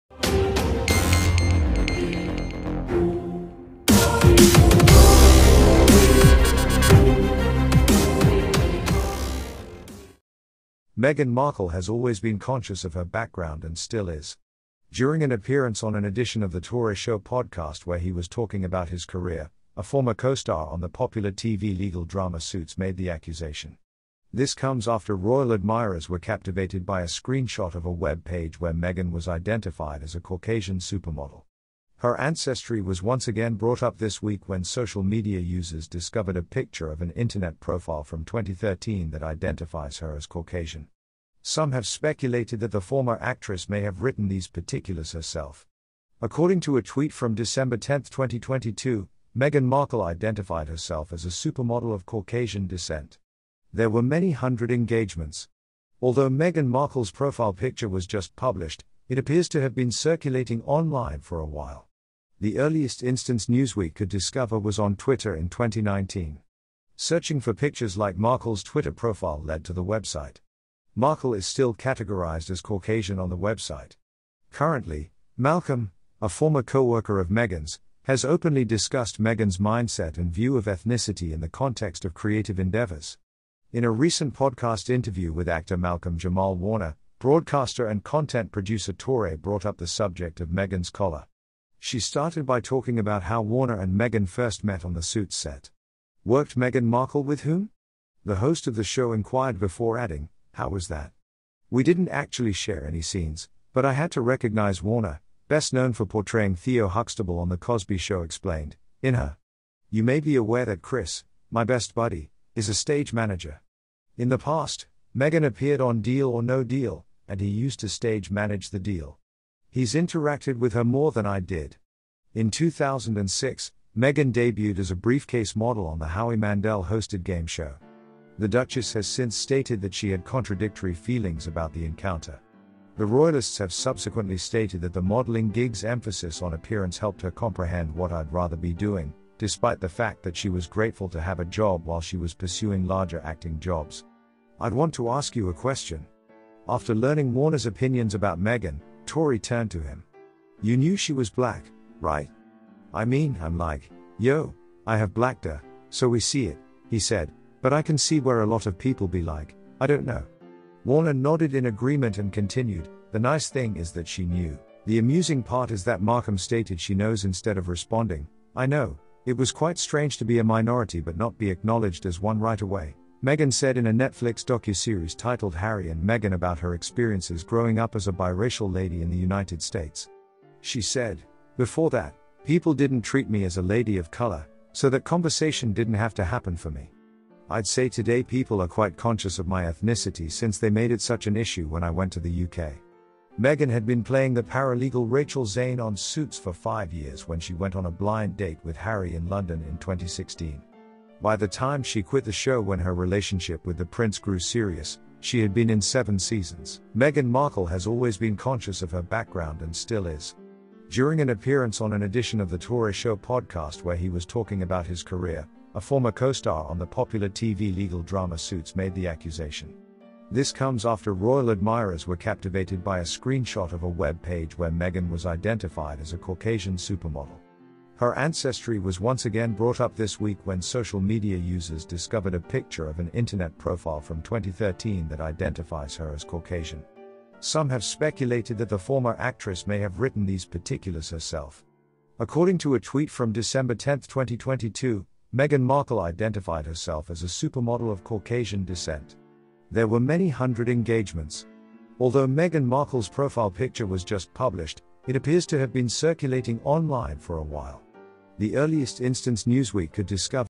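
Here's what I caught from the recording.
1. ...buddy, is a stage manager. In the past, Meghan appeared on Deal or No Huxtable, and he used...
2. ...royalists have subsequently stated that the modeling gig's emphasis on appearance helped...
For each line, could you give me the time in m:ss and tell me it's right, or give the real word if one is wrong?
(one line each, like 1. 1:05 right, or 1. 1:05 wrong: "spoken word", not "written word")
1. 1:51 wrong: "Deal", not "Huxtable"
2. 2:13 right.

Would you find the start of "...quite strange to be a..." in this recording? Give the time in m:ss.
2:49.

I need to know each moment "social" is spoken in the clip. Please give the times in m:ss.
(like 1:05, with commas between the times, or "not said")
0:34, 3:50.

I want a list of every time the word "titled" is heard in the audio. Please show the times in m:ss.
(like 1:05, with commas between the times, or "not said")
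2:55.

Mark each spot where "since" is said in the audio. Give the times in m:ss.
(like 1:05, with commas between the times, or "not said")
2:09, 3:10.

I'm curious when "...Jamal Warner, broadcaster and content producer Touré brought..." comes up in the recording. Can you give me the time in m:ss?
1:26.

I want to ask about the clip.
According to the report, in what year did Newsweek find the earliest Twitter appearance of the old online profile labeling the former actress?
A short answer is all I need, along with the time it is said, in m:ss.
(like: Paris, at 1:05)
2019, at 1:05.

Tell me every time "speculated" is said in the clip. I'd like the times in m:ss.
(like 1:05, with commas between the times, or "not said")
0:41, 3:57.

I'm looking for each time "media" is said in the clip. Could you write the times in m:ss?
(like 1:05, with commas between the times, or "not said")
0:35, 3:50.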